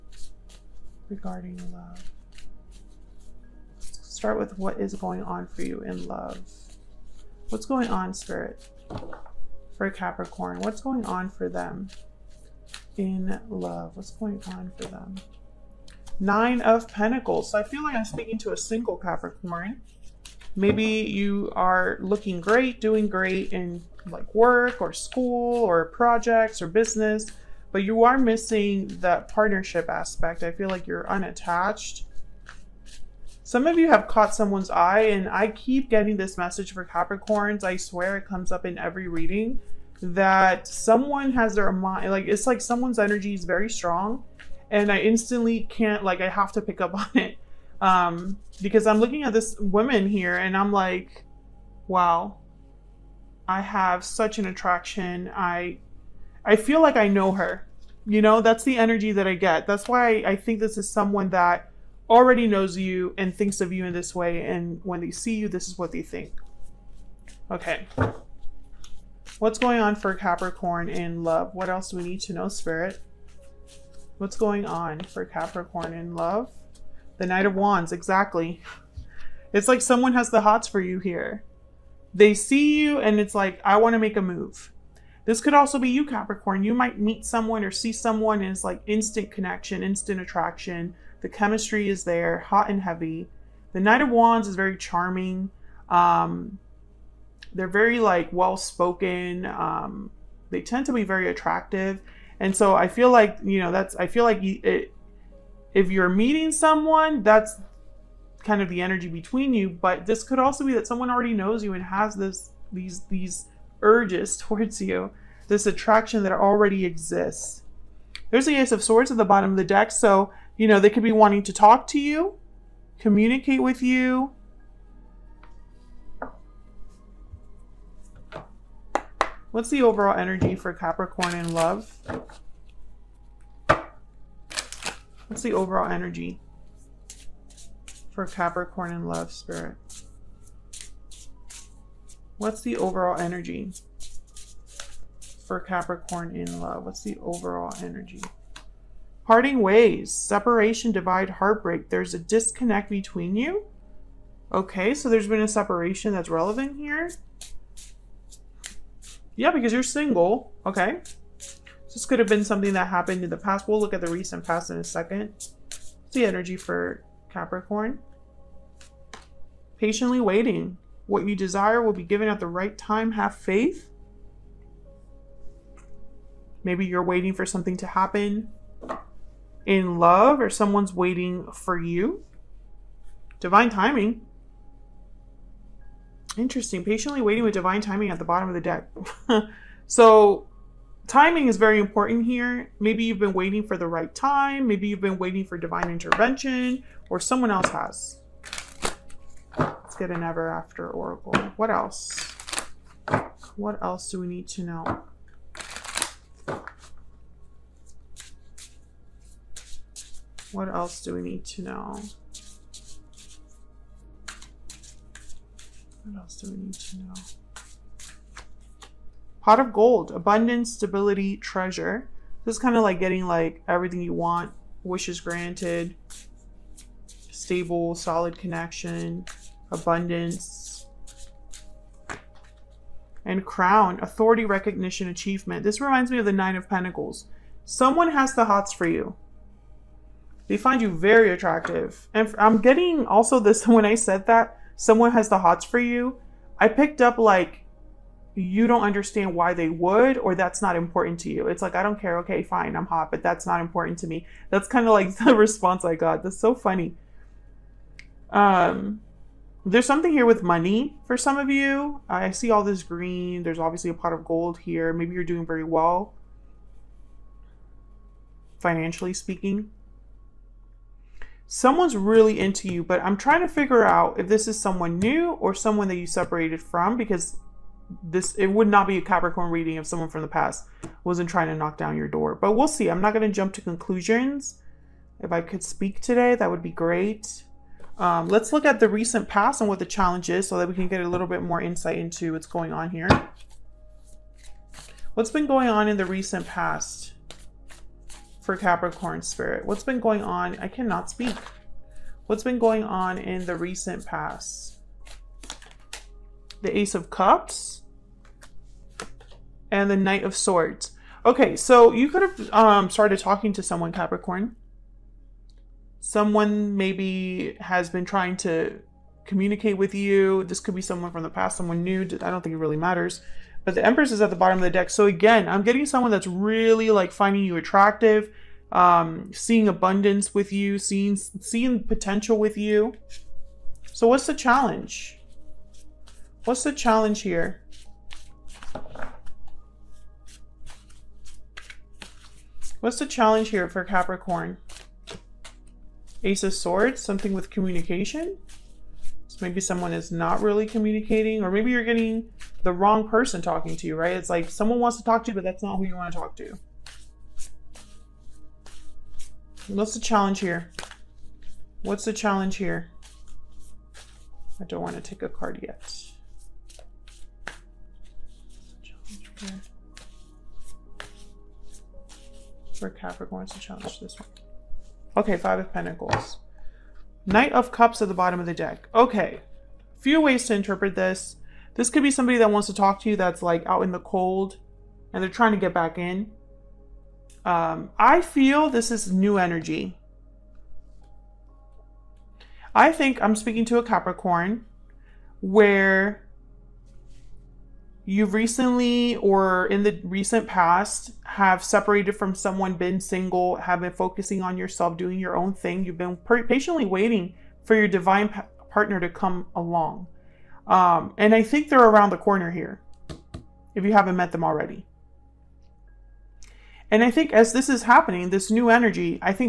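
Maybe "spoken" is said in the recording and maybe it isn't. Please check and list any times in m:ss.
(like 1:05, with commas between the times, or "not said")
1:38.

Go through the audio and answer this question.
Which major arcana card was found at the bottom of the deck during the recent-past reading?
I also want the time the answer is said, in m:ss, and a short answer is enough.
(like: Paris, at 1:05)
The Empress, at 5:23.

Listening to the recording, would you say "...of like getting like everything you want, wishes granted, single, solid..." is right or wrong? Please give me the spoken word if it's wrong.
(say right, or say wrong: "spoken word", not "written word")
wrong: "stable", not "single".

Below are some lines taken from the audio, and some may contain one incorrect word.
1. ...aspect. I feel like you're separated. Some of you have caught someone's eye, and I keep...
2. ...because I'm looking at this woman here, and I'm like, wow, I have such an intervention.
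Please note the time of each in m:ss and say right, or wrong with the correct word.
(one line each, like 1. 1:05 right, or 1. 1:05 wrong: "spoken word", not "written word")
1. 0:29 wrong: "unattached", not "separated"
2. 0:48 wrong: "attraction", not "intervention".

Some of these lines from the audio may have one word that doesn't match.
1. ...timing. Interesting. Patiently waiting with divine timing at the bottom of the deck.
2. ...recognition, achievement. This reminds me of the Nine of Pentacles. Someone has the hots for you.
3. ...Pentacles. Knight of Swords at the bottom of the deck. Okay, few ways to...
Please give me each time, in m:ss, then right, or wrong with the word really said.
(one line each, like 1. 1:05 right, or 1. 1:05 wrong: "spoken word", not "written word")
1. 3:03 right
2. 3:54 right
3. 6:15 wrong: "Cups", not "Swords".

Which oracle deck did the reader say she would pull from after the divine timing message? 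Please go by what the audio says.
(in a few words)
Ever After oracle.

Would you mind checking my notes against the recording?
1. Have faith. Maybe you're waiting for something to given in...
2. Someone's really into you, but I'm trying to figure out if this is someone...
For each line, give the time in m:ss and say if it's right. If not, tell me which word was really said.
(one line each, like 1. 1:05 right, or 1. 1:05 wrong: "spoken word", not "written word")
1. 2:53 wrong: "happen", not "given"
2. 4:31 right.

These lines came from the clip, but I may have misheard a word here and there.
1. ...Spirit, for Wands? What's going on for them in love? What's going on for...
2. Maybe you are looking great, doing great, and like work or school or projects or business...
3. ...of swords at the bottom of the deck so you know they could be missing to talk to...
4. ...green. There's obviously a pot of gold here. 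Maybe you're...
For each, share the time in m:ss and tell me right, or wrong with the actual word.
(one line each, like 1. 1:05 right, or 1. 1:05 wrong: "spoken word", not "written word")
1. 0:08 wrong: "Capricorn", not "Wands"
2. 0:20 right
3. 1:58 wrong: "wanting", not "missing"
4. 4:22 right.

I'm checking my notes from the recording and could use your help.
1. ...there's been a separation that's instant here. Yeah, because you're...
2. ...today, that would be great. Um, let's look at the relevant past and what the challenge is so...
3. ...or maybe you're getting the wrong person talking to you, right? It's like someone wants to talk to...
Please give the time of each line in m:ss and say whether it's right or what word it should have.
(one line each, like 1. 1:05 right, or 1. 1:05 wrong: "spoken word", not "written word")
1. 2:35 wrong: "relevant", not "instant"
2. 4:46 wrong: "recent", not "relevant"
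3. 5:51 right.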